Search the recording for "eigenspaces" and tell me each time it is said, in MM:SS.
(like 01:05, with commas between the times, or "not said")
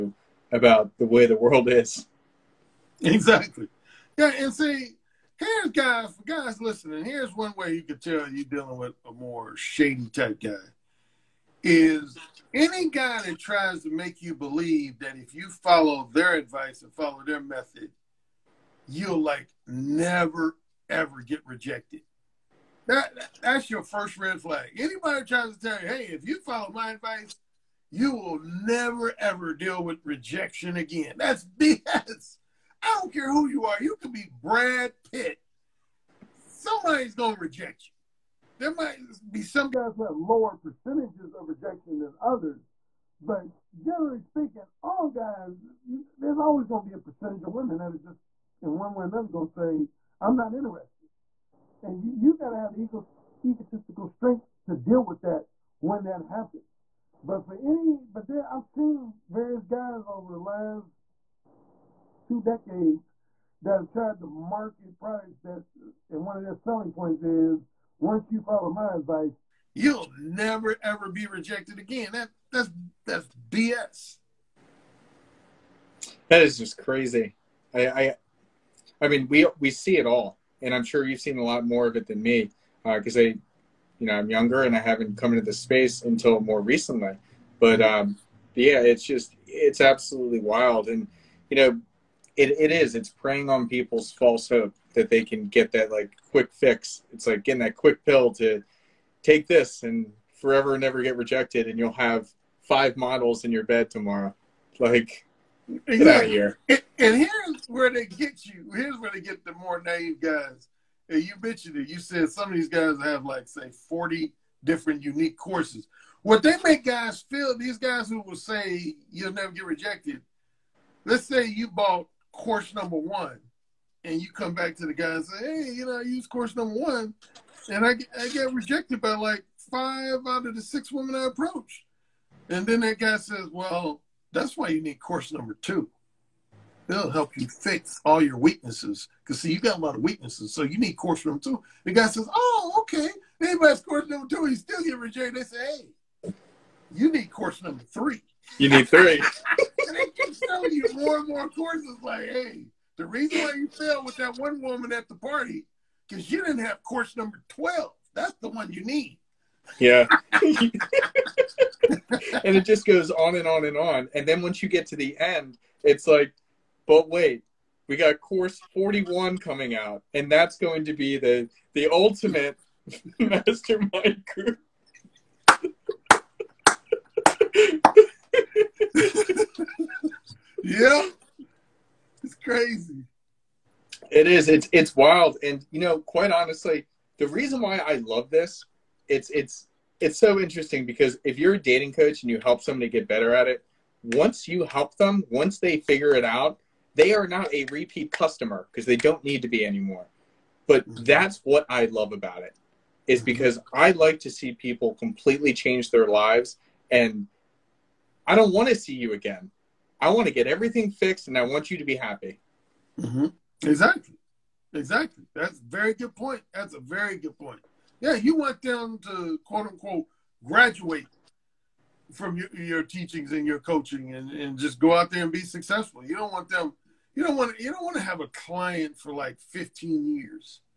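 not said.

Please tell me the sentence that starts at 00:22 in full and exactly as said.
That that's your first red flag.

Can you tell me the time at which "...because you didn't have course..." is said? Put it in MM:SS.
02:36.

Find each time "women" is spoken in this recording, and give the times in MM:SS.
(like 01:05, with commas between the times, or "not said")
00:47, 02:10.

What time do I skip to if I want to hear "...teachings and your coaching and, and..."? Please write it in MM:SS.
03:42.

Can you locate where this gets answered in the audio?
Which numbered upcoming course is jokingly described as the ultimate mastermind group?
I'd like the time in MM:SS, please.
02:48.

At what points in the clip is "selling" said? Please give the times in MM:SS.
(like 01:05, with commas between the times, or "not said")
01:06, 02:30.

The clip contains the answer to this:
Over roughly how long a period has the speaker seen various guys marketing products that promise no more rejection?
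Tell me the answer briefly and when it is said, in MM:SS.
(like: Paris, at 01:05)
2 decades, at 01:02.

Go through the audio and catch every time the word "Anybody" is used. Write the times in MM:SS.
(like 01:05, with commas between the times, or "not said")
00:24, 02:23.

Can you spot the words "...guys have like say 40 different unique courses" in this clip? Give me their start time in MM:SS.
01:52.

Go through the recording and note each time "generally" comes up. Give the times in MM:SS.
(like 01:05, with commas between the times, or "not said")
00:43.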